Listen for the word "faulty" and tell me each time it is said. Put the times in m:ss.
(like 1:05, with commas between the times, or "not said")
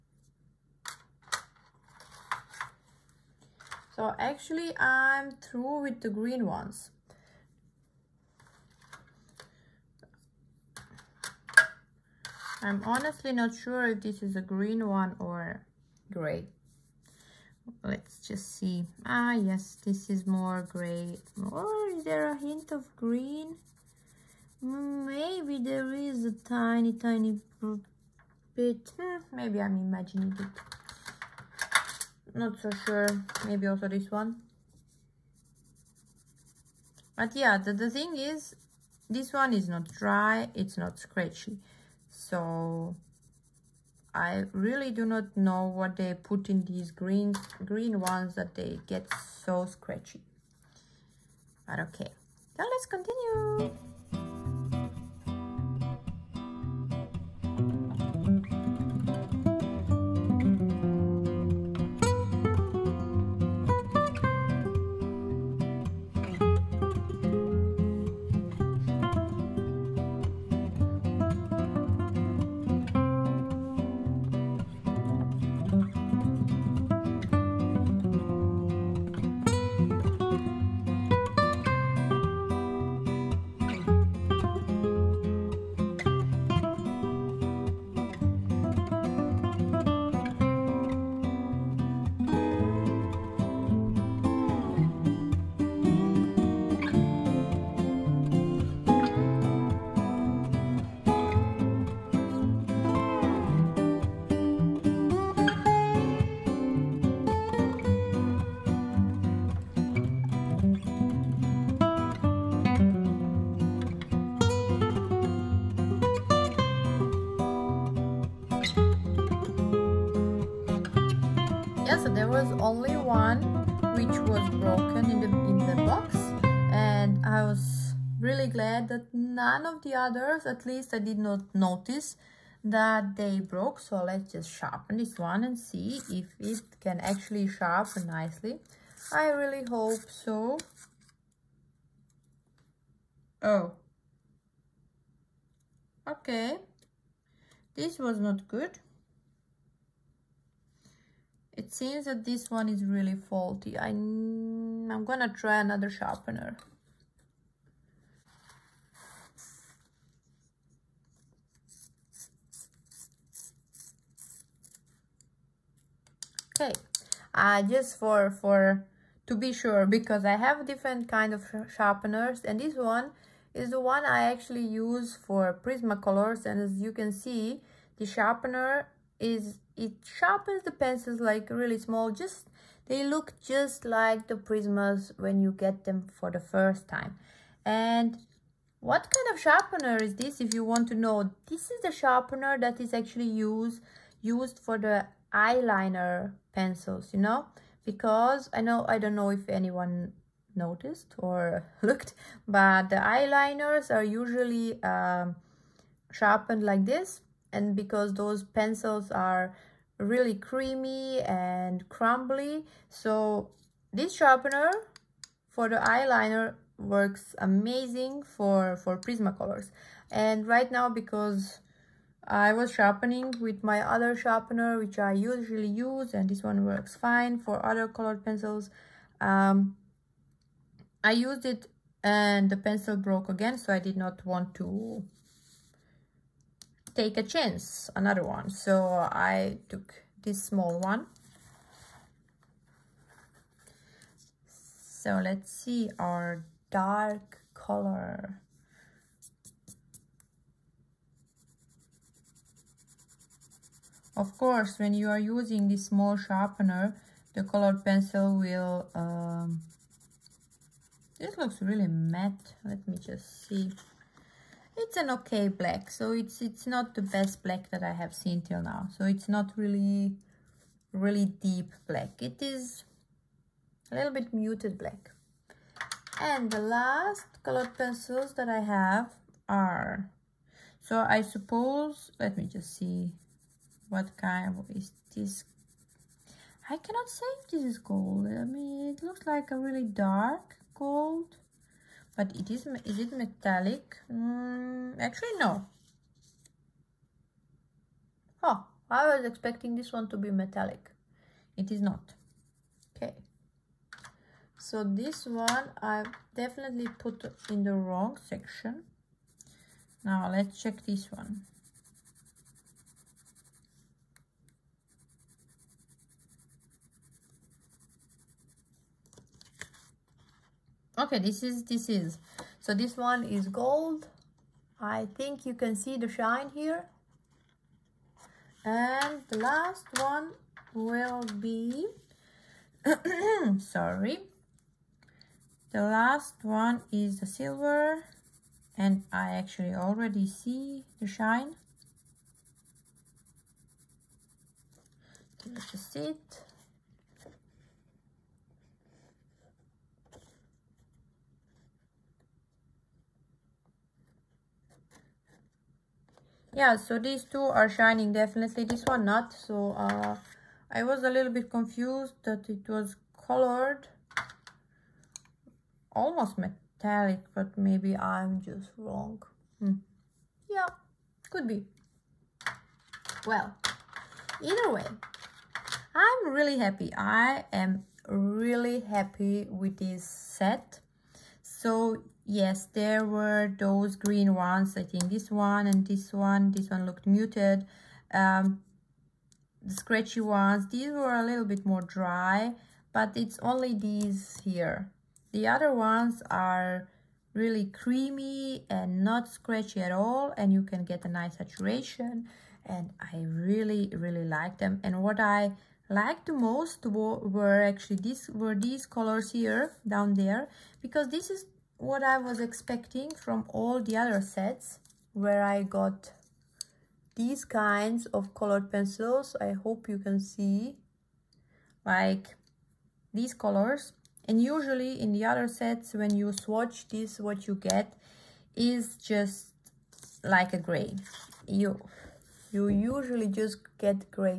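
2:33.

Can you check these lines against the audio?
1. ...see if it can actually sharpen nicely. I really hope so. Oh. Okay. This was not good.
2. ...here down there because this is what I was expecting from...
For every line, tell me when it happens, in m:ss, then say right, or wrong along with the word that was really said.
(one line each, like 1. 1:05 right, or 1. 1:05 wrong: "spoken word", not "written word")
1. 2:15 right
2. 6:49 right.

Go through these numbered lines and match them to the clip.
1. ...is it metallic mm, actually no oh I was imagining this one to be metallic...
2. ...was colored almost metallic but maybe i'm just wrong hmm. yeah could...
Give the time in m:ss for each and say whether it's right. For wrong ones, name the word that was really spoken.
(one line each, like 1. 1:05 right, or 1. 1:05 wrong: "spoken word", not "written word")
1. 4:52 wrong: "expecting", not "imagining"
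2. 6:02 right.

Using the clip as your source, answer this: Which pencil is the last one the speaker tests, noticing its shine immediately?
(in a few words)
silver.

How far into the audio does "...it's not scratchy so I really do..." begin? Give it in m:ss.
0:40.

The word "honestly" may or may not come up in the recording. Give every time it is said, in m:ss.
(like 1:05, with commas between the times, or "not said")
0:12.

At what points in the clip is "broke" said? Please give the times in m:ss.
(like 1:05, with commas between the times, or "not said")
2:13, 3:52.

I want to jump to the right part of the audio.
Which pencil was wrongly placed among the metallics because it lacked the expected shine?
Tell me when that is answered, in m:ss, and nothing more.
4:49.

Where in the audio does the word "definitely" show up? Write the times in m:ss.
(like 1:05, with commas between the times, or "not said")
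5:06, 5:58.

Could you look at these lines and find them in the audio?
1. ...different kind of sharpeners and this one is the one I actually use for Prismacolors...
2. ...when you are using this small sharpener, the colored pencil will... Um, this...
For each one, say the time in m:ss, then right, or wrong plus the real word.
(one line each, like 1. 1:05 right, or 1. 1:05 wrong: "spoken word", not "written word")
1. 2:50 right
2. 4:14 right.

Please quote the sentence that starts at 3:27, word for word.
And because those pencils are really creamy and crumbly, so this sharpener for the eyeliner works amazing for, for Prismacolors.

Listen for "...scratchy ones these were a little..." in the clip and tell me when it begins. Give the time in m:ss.
6:29.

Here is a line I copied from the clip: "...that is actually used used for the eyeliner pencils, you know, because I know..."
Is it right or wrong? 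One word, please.
right.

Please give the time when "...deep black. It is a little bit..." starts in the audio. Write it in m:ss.
4:31.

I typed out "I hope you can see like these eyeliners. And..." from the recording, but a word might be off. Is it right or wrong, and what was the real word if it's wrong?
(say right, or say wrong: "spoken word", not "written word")
wrong: "colors", not "eyeliners".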